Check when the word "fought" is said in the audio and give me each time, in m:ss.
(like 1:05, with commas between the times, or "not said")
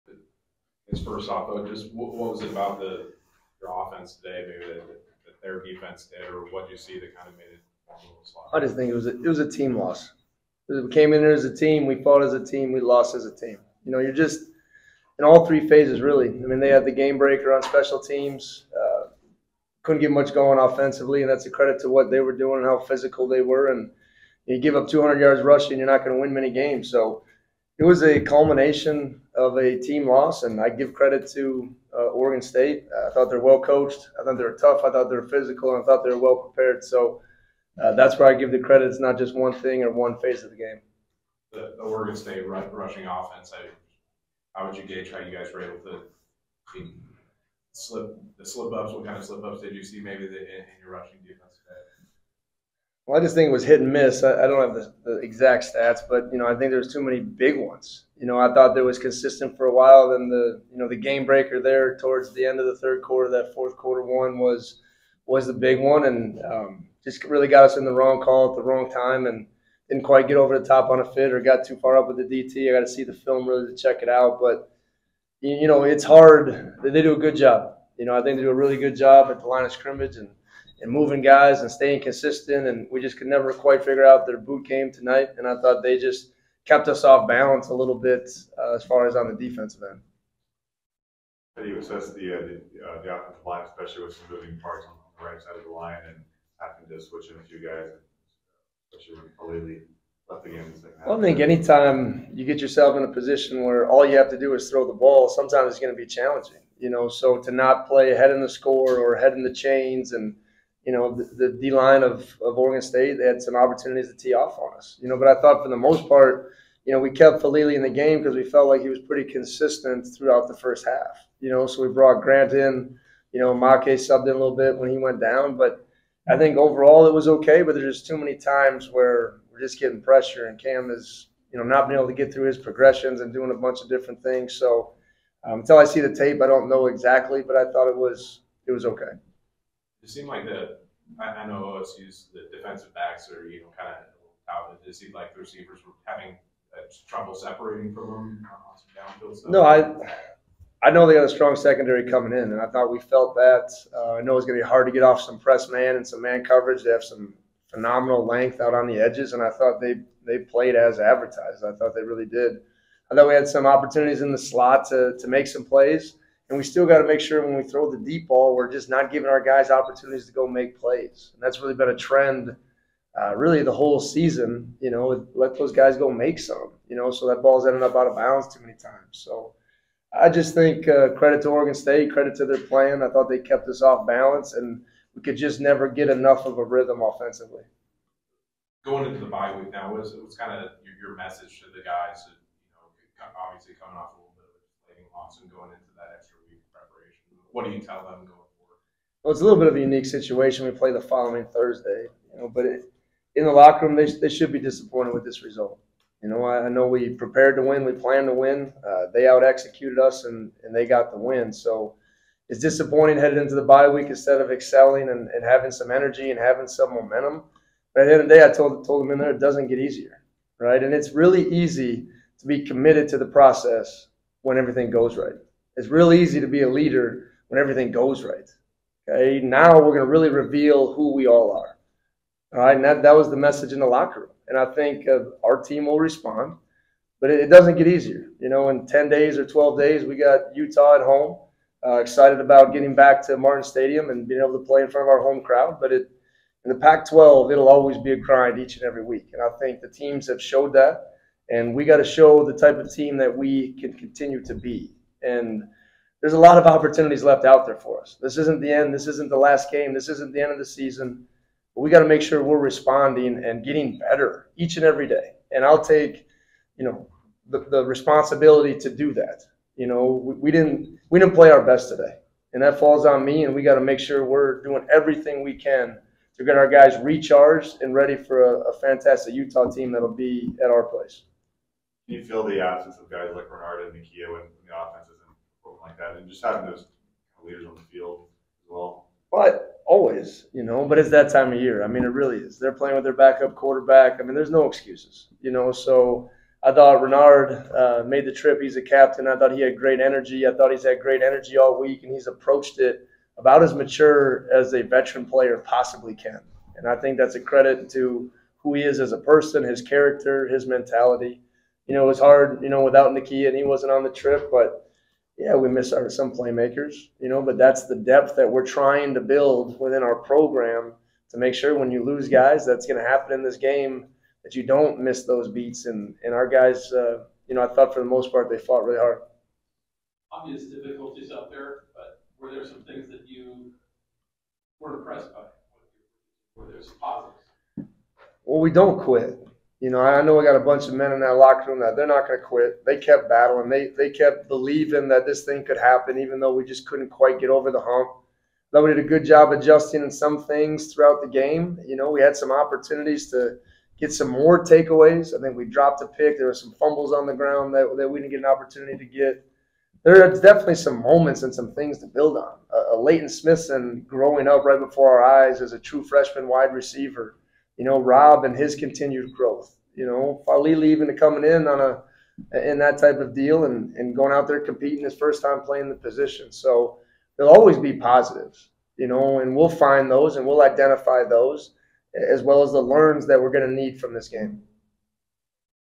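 0:12, 5:28.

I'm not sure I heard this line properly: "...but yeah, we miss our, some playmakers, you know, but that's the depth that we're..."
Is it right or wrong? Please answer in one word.
right.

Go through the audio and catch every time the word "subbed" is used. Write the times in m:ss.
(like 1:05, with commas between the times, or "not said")
2:03.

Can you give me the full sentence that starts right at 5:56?
There were some fumbles on the ground that, that we didn't get an opportunity to get.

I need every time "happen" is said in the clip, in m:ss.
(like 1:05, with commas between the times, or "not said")
5:23, 5:45.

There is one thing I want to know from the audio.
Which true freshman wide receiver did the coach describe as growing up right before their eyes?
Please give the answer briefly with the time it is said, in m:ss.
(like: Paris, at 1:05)
Leyton Smithson, at 6:02.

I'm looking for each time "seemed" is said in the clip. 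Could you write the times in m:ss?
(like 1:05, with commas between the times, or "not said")
2:20, 2:24.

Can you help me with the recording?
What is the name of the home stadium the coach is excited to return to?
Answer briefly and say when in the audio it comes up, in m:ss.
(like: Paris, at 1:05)
Martin Stadium, at 4:03.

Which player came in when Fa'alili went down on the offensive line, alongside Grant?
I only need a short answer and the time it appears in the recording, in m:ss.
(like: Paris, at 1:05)
Ma'ake, at 2:03.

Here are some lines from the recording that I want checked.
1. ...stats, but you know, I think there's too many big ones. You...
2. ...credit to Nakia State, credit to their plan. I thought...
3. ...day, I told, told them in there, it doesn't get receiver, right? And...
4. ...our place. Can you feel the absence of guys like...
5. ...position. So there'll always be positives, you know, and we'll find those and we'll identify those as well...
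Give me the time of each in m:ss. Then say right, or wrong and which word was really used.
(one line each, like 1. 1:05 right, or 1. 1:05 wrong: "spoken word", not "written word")
1. 0:55 right
2. 3:01 wrong: "Oregon", not "Nakia"
3. 3:38 wrong: "easier", not "receiver"
4. 4:40 right
5. 6:15 right.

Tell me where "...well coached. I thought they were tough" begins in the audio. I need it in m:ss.
0:33.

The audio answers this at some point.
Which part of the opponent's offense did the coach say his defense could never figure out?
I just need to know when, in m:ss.
1:24.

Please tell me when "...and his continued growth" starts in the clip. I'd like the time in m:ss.
6:08.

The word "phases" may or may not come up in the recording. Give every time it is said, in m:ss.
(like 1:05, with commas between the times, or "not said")
0:15, 0:40.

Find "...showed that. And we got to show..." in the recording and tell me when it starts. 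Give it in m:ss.
4:10.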